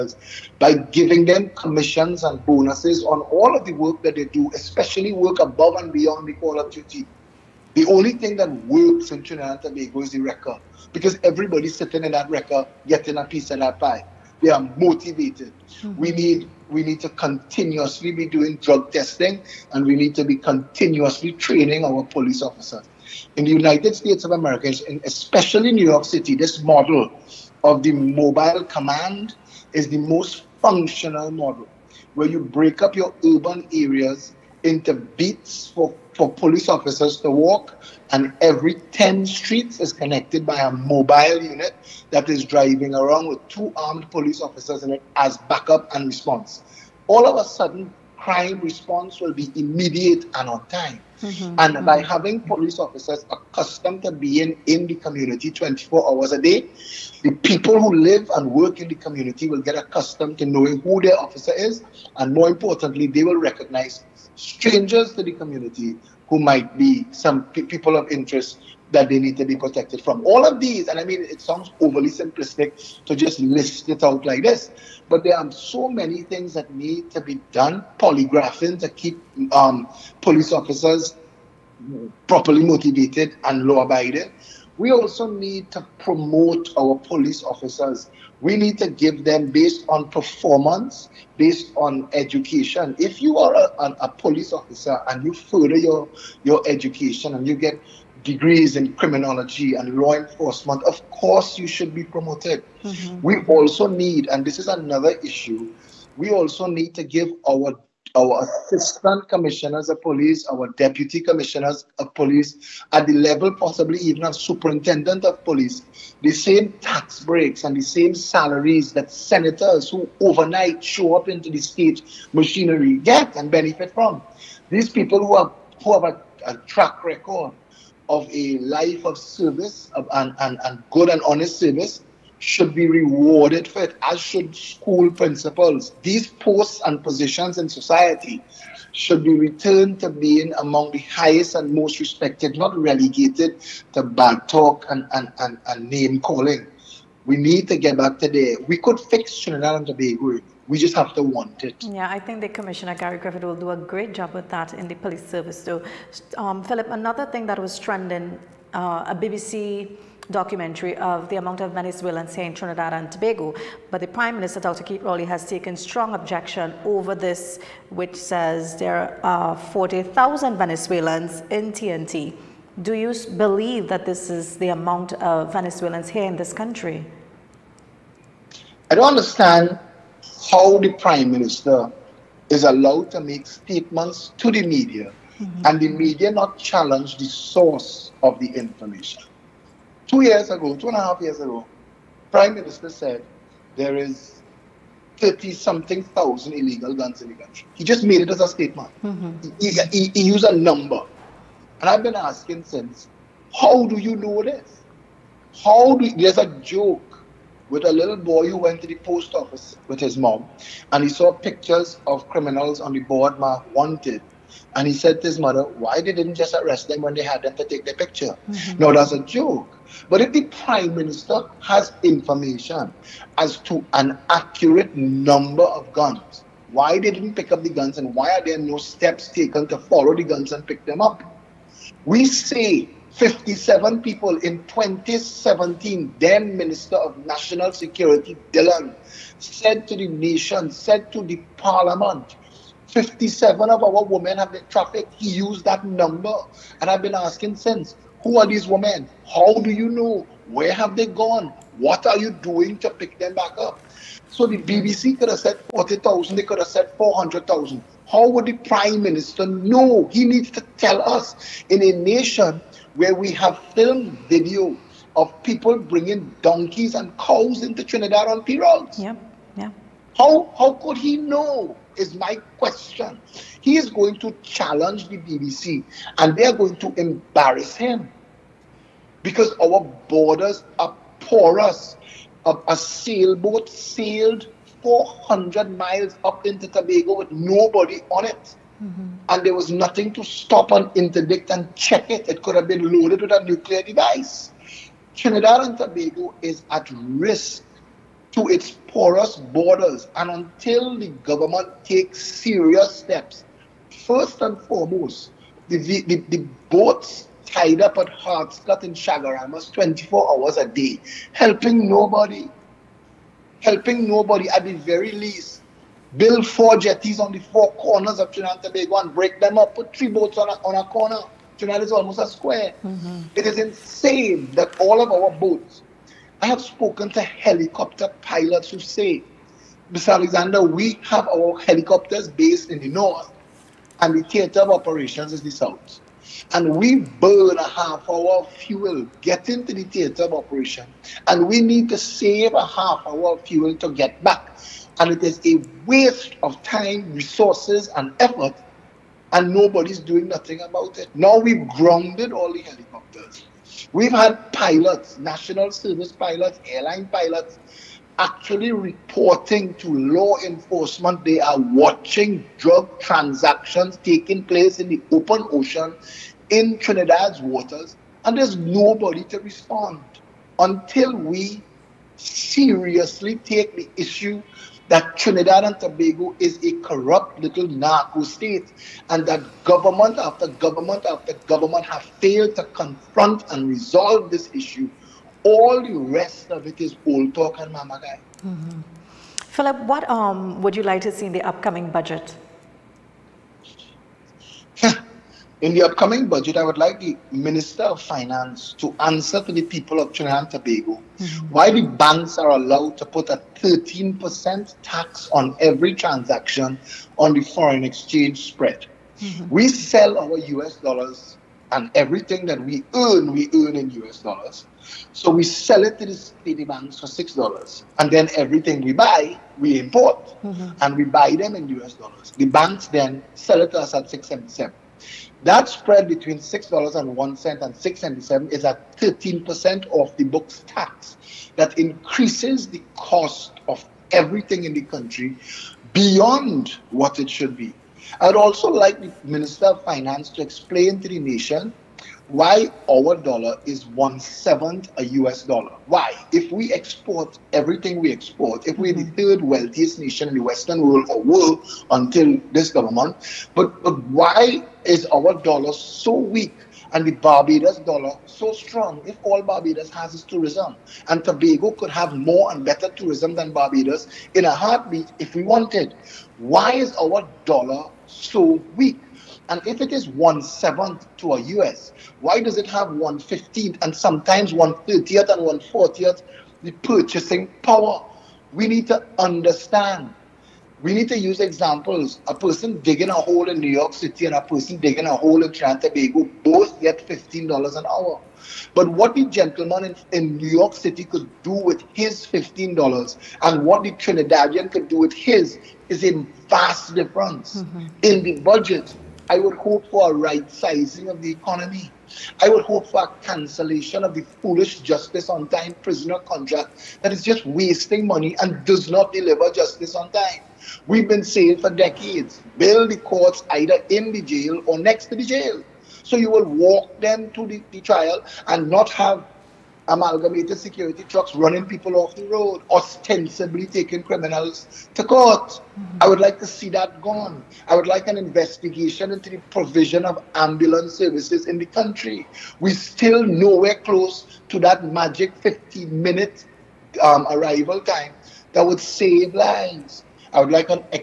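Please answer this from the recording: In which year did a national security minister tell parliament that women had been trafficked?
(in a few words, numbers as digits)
2017.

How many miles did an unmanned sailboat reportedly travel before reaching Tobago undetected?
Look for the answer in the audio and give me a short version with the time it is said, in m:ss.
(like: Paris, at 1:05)
400, at 4:44.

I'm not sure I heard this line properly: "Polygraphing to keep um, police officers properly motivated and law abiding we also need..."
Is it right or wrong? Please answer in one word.
right.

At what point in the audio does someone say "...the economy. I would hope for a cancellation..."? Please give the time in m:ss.
8:21.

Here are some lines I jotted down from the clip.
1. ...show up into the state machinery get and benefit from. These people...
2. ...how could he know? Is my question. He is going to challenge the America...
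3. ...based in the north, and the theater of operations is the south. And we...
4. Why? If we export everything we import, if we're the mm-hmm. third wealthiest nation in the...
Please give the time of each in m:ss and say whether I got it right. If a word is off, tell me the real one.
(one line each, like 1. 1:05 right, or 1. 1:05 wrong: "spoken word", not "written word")
1. 2:00 right
2. 4:30 wrong: "BBC", not "America"
3. 5:32 right
4. 7:25 wrong: "export", not "import".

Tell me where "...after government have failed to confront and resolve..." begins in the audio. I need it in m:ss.
6:21.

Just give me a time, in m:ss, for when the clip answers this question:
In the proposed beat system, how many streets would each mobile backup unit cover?
0:38.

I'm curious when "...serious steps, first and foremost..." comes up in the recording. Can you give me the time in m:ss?
5:02.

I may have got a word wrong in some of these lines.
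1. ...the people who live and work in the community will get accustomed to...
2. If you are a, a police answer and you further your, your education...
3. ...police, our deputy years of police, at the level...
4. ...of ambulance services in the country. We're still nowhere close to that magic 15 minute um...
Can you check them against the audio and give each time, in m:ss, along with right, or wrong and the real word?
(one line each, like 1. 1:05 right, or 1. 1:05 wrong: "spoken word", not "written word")
1. 0:57 right
2. 1:32 wrong: "officer", not "answer"
3. 1:50 wrong: "commissioners", not "years"
4. 8:50 right.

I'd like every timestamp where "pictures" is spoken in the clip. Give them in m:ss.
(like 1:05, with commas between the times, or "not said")
3:31, 3:37.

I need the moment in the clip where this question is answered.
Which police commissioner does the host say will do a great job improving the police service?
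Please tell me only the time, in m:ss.
2:32.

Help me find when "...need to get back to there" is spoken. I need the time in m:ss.
2:27.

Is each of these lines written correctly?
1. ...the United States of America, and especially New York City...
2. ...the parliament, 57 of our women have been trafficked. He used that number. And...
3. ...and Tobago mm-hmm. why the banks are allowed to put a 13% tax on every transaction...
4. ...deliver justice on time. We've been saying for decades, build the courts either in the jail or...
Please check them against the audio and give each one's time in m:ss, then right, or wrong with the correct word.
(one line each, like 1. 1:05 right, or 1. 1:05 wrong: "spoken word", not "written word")
1. 0:23 right
2. 4:01 right
3. 6:40 right
4. 8:29 right.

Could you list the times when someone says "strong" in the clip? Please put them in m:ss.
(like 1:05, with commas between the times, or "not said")
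2:45, 7:38.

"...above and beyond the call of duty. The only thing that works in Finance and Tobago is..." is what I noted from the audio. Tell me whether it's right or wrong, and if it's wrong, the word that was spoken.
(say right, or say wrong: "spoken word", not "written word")
wrong: "Trinidad", not "Finance".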